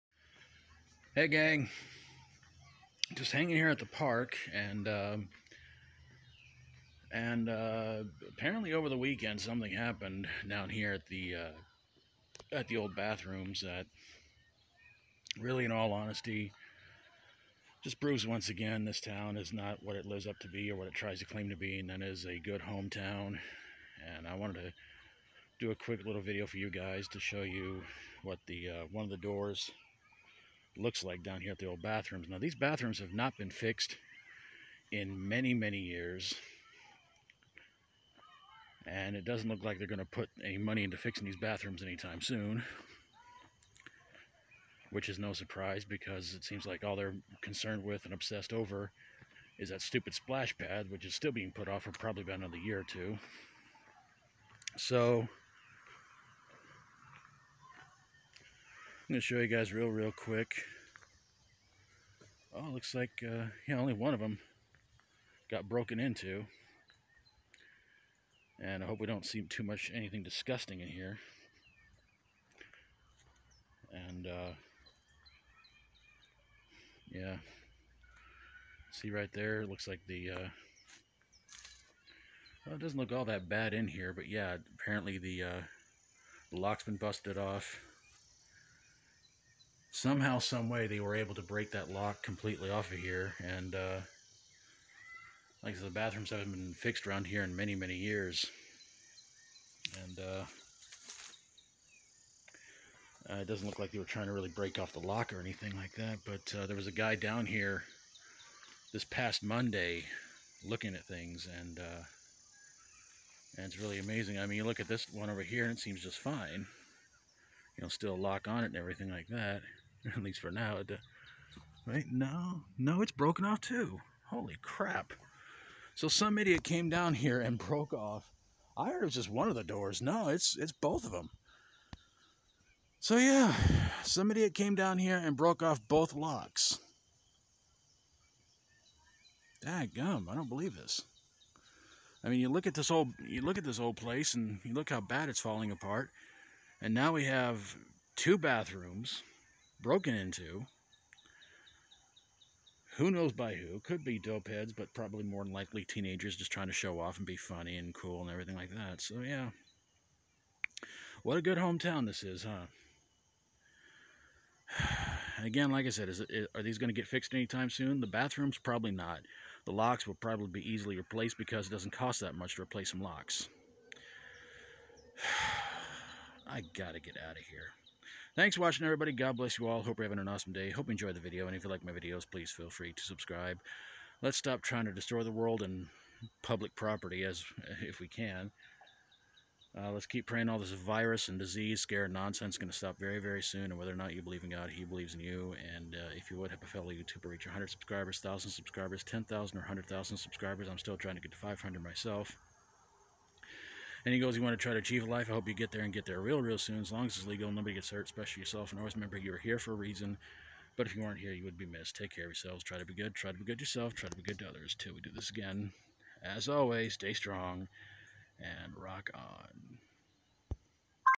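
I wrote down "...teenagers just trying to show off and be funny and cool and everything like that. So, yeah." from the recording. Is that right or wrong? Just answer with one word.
right.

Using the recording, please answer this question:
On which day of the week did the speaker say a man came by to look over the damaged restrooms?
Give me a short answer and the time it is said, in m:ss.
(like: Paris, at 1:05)
Monday, at 1:49.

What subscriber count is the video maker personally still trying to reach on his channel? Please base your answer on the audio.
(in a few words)
500.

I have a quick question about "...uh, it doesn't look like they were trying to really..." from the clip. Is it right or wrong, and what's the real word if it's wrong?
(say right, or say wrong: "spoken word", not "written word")
right.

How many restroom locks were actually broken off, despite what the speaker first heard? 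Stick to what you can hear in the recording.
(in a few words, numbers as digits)
2.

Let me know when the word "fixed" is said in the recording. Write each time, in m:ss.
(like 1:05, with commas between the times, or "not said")
0:33, 1:36, 2:47.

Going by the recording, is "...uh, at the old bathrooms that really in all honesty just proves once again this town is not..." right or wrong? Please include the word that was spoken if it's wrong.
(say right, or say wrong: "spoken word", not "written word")
right.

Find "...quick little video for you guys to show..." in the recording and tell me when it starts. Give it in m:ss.
0:25.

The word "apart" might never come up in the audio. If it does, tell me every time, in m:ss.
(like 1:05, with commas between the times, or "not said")
2:25.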